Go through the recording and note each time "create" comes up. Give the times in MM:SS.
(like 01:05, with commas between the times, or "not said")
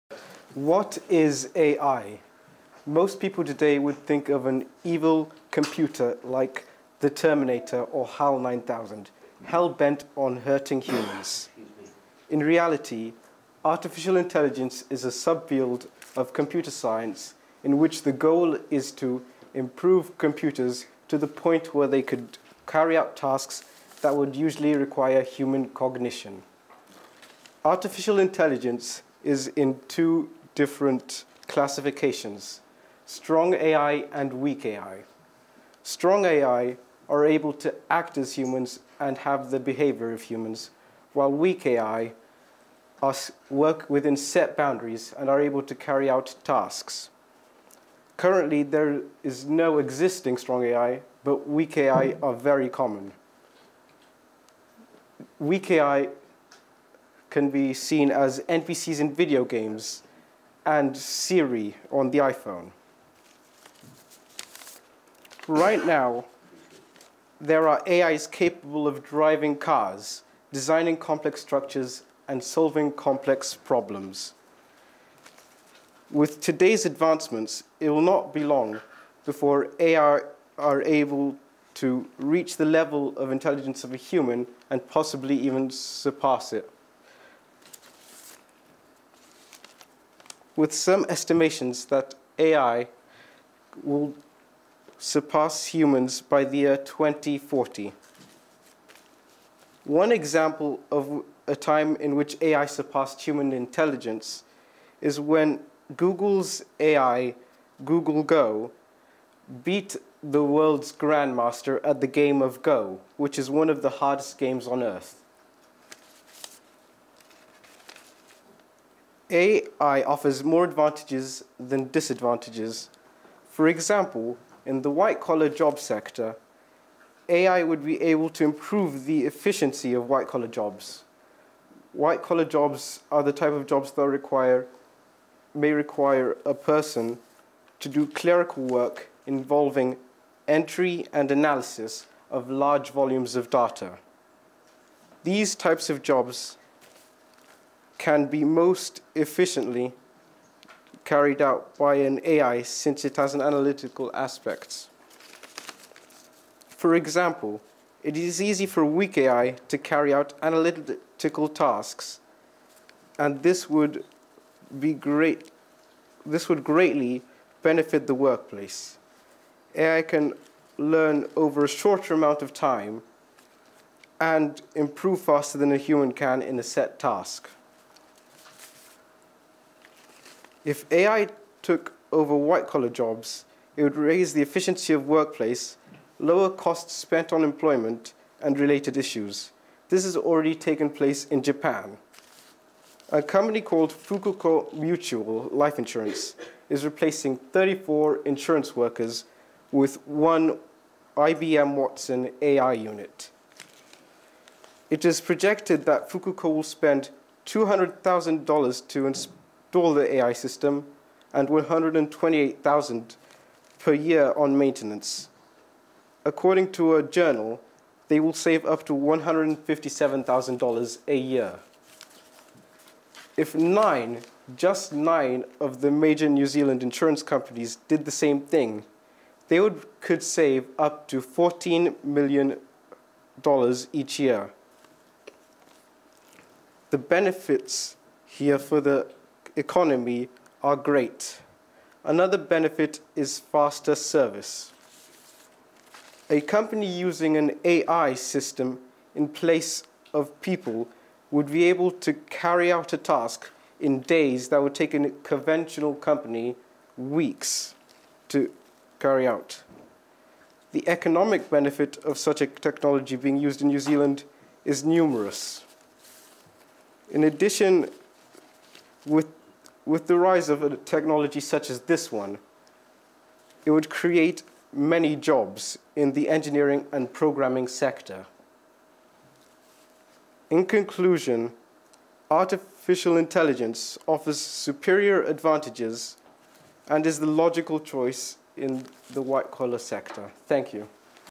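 04:33.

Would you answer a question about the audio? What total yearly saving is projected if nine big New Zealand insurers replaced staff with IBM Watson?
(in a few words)
$14 million.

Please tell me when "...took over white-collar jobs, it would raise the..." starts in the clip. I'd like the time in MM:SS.
03:01.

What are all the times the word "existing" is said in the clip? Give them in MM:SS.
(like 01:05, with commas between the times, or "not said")
00:49.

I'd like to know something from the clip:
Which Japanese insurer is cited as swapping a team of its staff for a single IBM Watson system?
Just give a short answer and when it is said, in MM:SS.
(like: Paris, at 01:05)
Fukuko Mutual Life Insurance, at 03:13.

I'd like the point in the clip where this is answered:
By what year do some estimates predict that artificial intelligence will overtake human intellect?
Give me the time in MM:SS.
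01:36.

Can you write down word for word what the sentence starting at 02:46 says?
This would greatly benefit the workplace.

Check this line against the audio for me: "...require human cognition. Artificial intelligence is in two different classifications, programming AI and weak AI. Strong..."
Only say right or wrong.
wrong.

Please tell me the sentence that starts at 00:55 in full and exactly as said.
Weak AI can be seen as NPCs in video games, and Siri on the iPhone.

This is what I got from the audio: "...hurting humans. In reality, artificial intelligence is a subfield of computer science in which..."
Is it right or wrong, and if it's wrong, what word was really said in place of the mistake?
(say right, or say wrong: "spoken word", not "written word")
right.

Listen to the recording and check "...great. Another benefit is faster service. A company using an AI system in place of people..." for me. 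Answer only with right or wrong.
right.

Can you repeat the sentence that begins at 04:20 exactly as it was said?
The economic benefit of such a technology being used in New Zealand is numerous.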